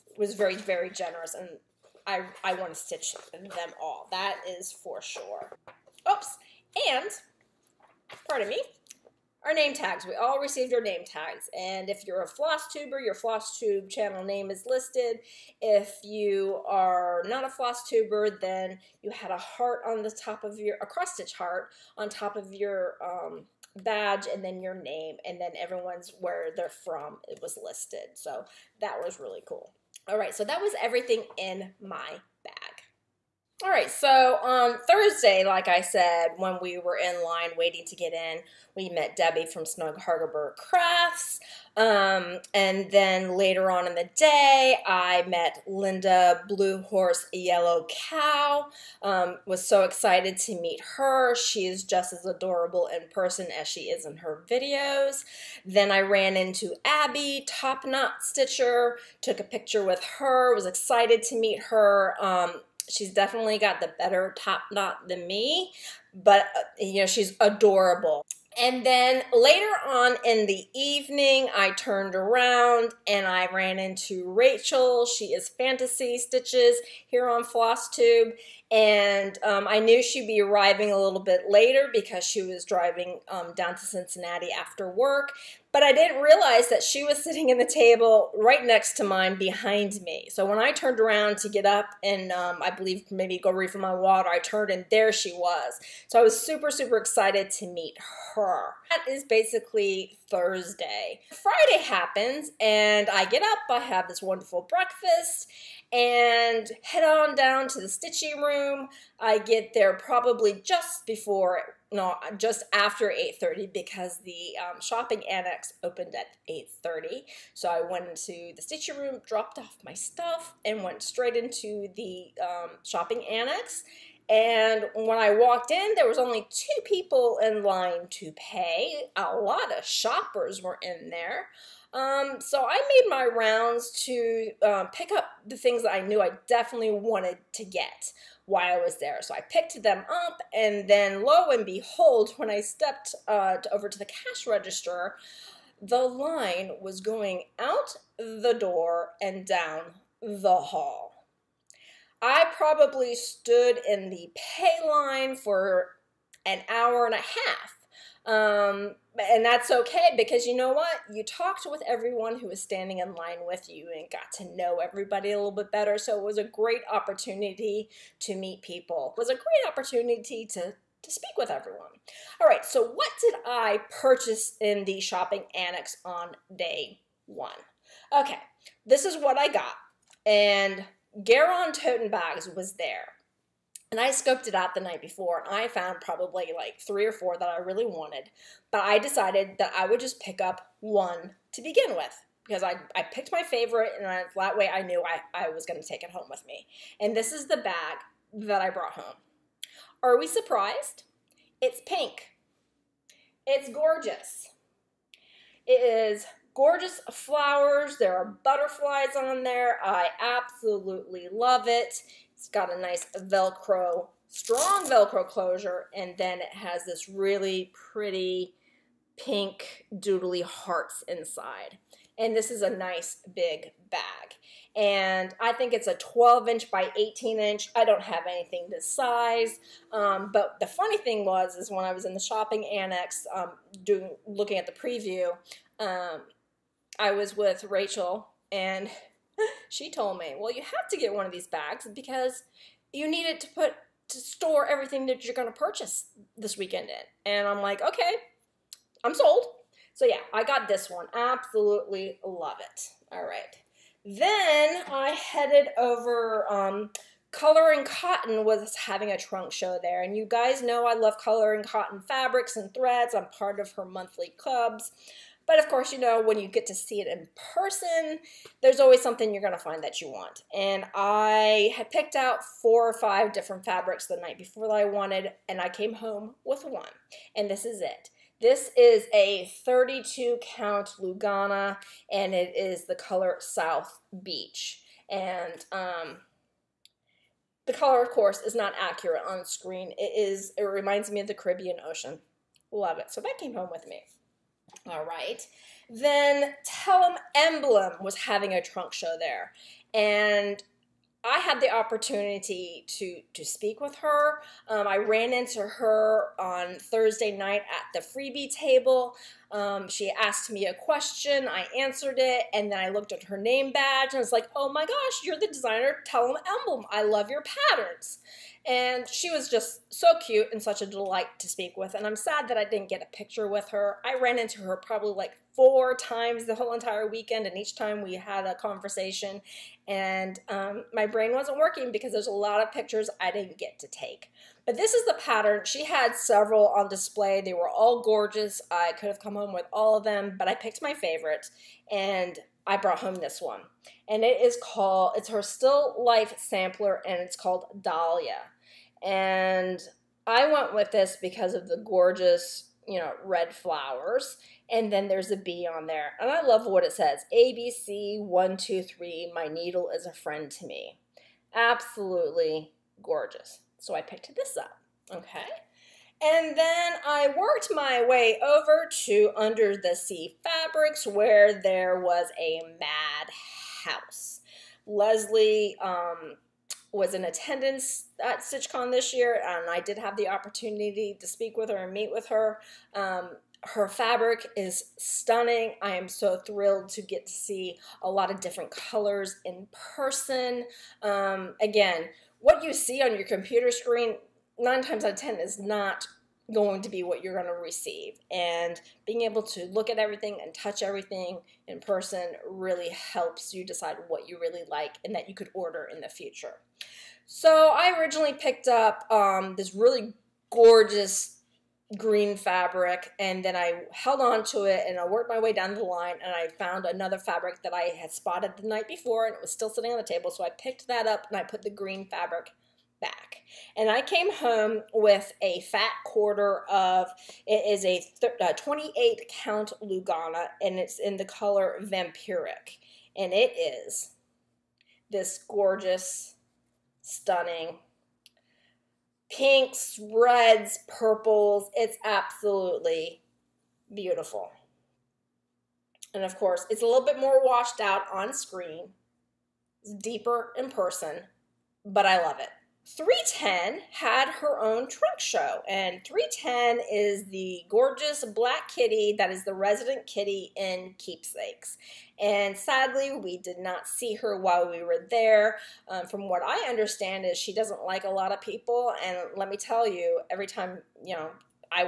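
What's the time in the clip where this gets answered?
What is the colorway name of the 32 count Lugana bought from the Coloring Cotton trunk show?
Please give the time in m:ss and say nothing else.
4:43.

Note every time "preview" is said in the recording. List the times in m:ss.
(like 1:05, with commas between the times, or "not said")
3:54.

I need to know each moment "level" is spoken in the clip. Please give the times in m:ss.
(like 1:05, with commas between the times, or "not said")
not said.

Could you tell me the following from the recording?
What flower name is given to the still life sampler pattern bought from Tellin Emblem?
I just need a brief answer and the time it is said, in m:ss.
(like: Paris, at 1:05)
Dahlia, at 5:47.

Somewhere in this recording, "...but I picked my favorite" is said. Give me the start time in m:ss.
5:40.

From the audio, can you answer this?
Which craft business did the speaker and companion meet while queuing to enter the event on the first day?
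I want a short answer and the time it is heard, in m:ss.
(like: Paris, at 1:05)
Snug Harbor Crafts, at 0:39.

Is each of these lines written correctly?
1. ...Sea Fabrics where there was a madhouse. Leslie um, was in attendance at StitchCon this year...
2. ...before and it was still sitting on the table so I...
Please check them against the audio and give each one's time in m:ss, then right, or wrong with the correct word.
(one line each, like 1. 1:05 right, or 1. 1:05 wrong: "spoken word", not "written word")
1. 6:09 right
2. 6:58 right.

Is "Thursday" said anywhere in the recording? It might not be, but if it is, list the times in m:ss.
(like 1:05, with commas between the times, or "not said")
0:34, 1:40, 5:06.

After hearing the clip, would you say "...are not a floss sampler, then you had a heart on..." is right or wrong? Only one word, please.
wrong.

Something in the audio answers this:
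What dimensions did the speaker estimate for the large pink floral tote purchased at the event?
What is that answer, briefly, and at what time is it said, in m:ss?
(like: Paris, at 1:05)
12 inch by 18 inch, at 3:45.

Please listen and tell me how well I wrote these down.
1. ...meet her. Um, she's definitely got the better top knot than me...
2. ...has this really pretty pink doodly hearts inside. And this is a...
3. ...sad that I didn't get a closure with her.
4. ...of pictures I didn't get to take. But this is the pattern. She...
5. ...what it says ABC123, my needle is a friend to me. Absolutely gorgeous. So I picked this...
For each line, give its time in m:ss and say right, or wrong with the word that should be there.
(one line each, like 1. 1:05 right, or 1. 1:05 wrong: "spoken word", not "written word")
1. 1:01 right
2. 3:36 right
3. 5:22 wrong: "picture", not "closure"
4. 5:32 right
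5. 5:56 right.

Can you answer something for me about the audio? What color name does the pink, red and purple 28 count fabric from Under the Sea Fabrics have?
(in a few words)
Vampiric.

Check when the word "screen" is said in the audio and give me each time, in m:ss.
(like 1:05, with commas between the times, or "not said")
4:49, 6:33, 7:28.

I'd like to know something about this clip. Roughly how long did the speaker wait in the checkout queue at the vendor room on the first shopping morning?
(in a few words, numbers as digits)
an hour and a half.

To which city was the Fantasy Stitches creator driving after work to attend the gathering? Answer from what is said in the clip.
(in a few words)
Cincinnati.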